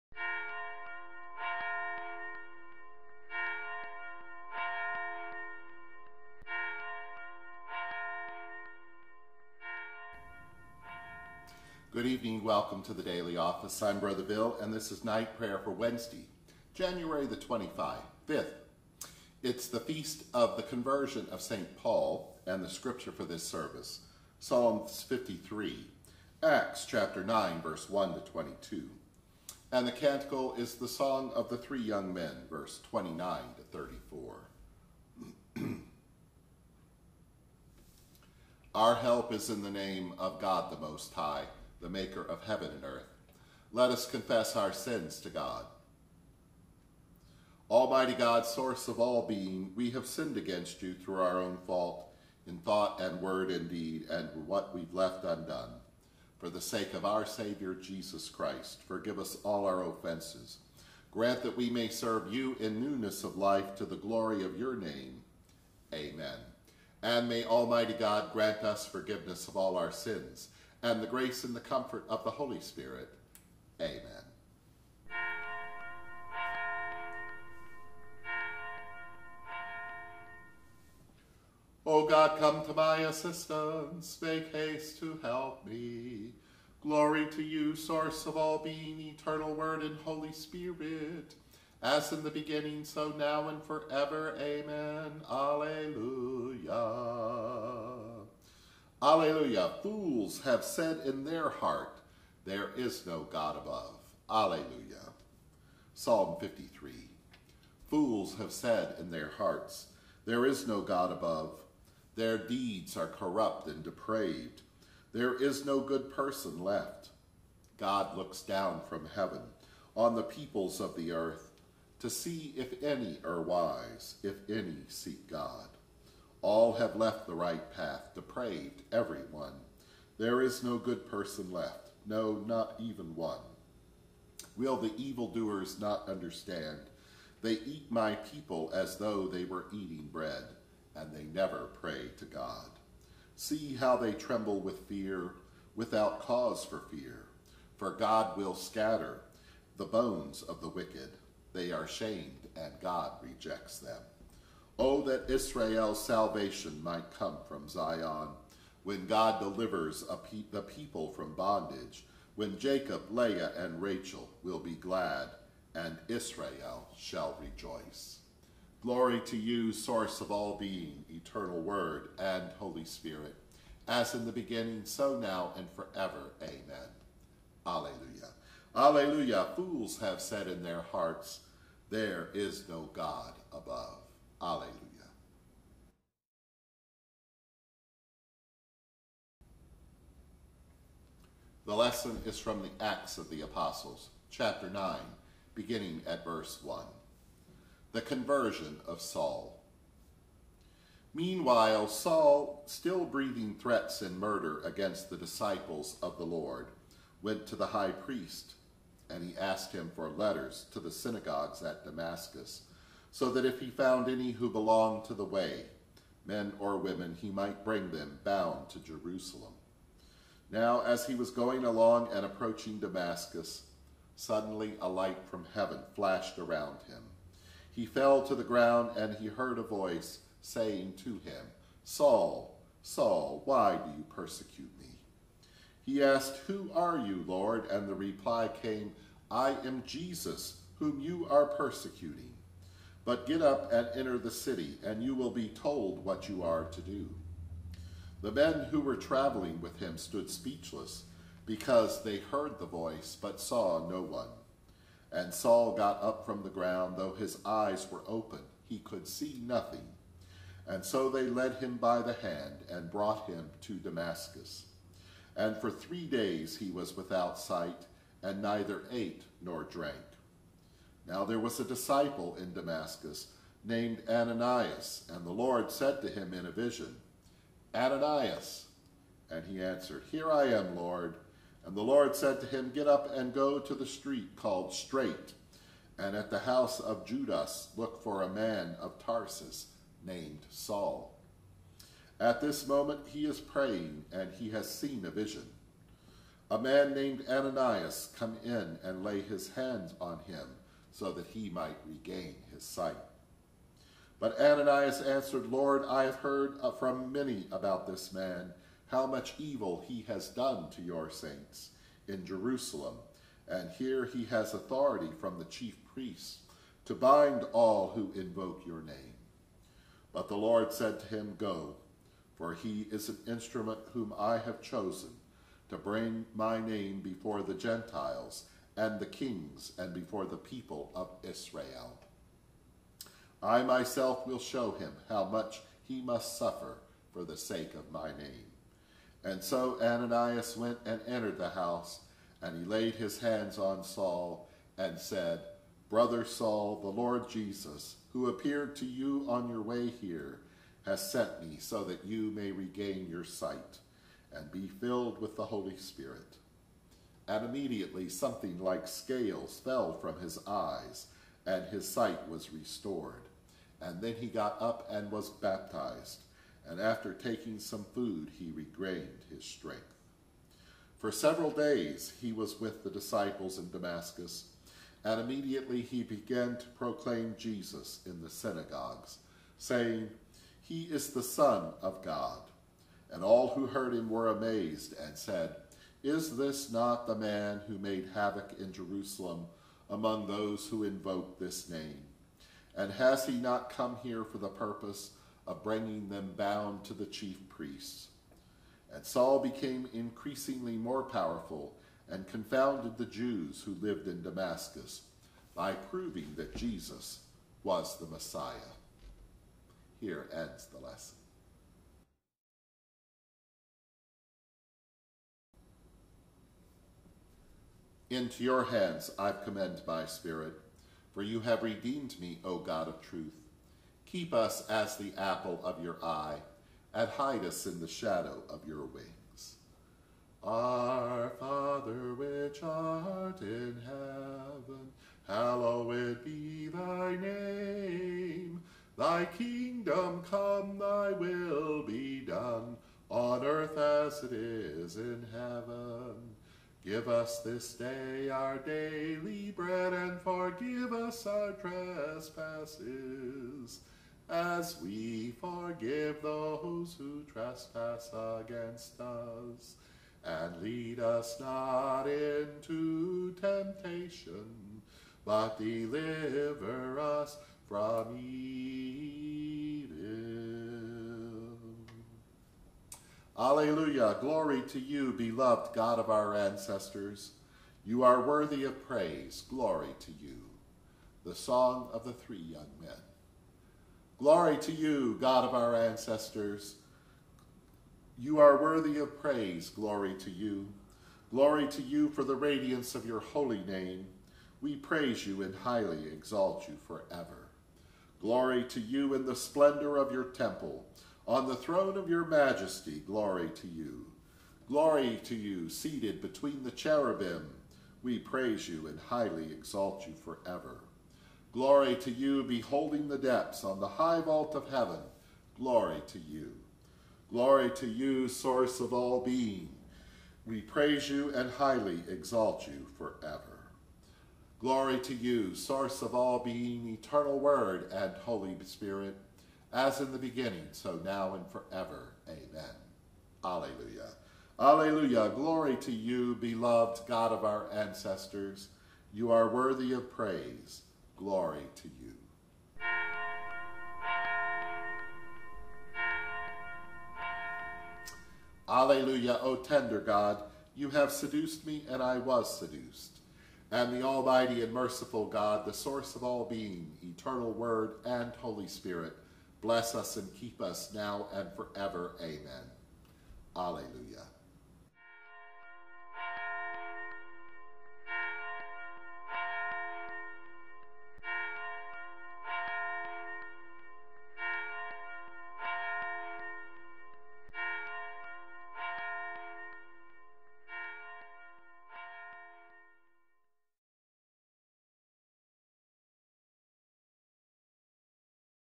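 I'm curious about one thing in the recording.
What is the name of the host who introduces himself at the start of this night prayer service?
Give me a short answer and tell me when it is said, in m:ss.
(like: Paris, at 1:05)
Brother Bill, at 0:13.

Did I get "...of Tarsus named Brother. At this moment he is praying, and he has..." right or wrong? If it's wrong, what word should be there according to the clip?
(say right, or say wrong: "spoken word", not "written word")
wrong: "Saul", not "Brother".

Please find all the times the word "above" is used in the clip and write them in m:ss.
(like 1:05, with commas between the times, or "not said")
1:43, 1:51, 3:03.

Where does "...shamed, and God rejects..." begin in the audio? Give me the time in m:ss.
2:31.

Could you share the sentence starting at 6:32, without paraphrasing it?
And has he not come here for the purpose of bringing them bound to the chief priests?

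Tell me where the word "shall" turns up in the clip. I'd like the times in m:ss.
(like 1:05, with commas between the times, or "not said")
2:46.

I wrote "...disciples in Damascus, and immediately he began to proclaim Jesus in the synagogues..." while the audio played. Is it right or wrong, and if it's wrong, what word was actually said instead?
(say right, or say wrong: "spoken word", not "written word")
right.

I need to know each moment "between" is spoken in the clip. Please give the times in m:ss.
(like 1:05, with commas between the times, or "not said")
8:26.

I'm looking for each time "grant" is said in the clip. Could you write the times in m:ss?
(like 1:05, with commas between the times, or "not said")
1:01, 1:08.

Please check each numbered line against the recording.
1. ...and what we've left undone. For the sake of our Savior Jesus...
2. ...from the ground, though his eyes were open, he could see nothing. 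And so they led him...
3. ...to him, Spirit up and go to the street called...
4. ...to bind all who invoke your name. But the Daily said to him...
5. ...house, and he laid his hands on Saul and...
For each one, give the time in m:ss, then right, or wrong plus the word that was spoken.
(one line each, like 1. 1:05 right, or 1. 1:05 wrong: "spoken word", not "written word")
1. 0:54 right
2. 4:16 right
3. 4:42 wrong: "Get", not "Spirit"
4. 5:16 wrong: "Lord", not "Daily"
5. 5:41 right.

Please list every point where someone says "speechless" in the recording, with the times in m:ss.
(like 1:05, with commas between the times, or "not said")
4:10.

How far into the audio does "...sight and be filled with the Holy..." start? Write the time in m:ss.
5:53.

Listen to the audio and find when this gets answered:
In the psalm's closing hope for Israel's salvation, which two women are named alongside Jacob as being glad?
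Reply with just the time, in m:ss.
2:43.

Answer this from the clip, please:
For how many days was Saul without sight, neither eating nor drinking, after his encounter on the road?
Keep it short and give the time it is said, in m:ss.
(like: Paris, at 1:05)
3, at 4:25.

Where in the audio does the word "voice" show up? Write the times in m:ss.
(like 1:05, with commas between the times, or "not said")
3:49, 4:12.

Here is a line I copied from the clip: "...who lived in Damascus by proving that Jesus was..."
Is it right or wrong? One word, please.
right.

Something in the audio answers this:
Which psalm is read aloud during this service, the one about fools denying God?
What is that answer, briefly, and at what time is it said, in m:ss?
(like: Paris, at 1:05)
Psalm 53, at 1:45.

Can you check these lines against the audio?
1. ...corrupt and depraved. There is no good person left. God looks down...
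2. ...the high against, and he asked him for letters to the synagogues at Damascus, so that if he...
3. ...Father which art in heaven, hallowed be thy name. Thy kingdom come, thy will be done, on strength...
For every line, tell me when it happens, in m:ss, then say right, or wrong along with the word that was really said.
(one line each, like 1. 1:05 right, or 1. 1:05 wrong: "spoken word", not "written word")
1. 1:53 right
2. 3:27 wrong: "priest", not "against"
3. 7:11 wrong: "earth", not "strength".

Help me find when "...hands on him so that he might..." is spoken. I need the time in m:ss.
4:59.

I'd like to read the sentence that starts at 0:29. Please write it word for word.
And the canticle is the song of the three young men, verse 29 to 34.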